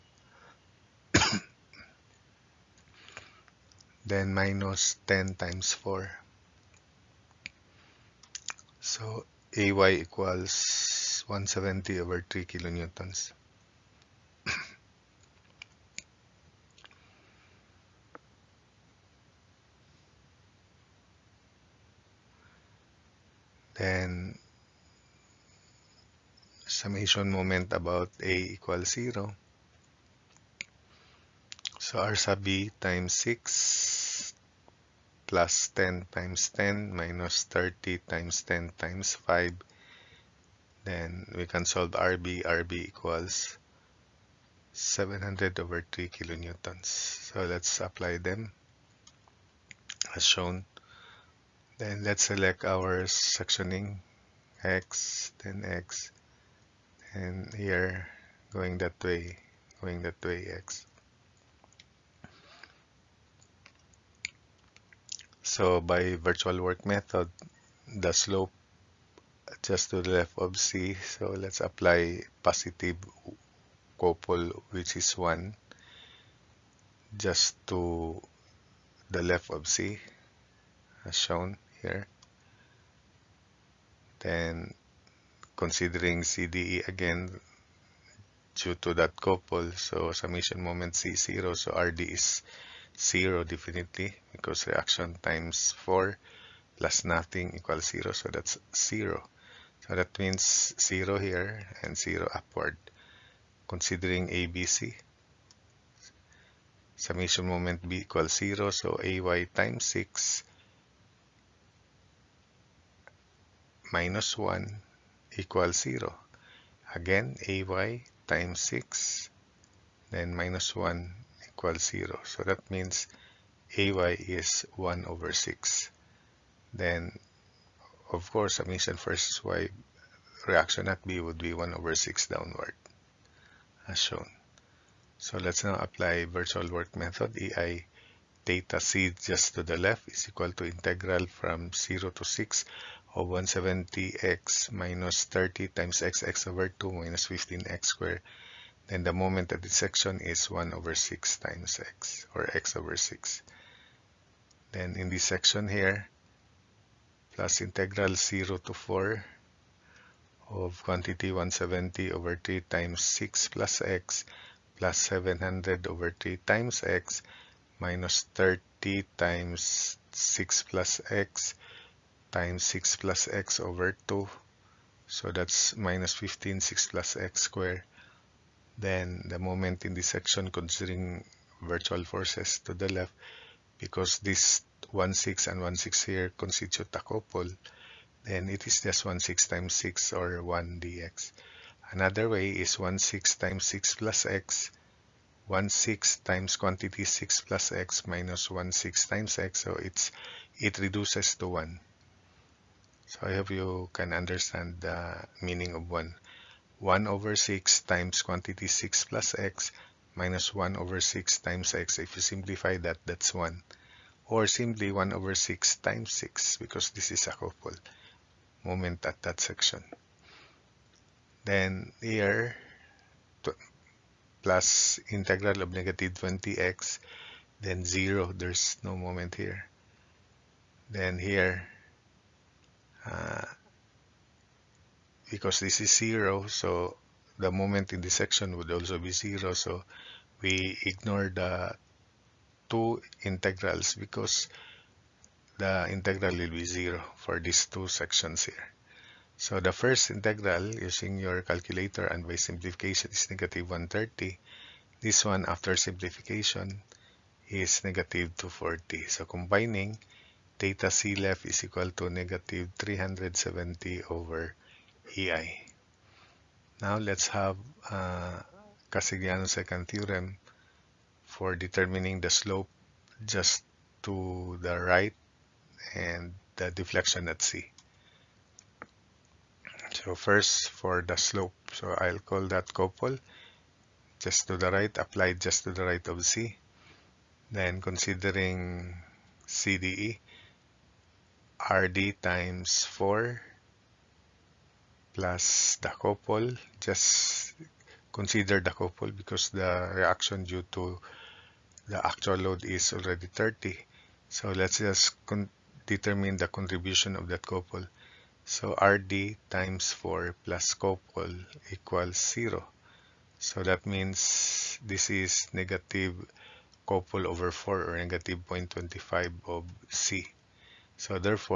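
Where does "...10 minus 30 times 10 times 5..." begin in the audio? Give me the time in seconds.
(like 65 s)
36 s.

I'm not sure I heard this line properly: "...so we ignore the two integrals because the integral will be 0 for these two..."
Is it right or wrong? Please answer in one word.
right.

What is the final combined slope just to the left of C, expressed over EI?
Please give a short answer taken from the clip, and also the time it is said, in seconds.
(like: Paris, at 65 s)
-370/EI, at 262 s.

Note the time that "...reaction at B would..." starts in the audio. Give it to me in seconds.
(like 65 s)
130 s.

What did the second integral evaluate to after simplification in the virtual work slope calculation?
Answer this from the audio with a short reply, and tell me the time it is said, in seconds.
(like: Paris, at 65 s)
-240, at 257 s.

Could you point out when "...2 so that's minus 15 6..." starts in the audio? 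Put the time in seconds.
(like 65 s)
174 s.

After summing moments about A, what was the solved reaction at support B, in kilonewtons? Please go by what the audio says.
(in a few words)
700/3.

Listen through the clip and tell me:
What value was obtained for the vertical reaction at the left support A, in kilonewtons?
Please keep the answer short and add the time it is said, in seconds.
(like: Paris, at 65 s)
170/3, at 11 s.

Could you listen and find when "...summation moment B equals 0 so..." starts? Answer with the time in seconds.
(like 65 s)
106 s.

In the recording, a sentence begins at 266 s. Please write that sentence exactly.
Now let's have uh, Castigliano's second theorem for determining the slope just to the right and the deflection at C.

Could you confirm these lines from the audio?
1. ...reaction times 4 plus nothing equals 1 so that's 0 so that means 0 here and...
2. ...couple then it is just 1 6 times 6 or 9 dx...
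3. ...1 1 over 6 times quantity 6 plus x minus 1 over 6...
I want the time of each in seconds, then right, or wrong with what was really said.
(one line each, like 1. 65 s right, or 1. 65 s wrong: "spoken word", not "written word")
1. 94 s wrong: "0", not "1"
2. 187 s wrong: "1", not "9"
3. 205 s right.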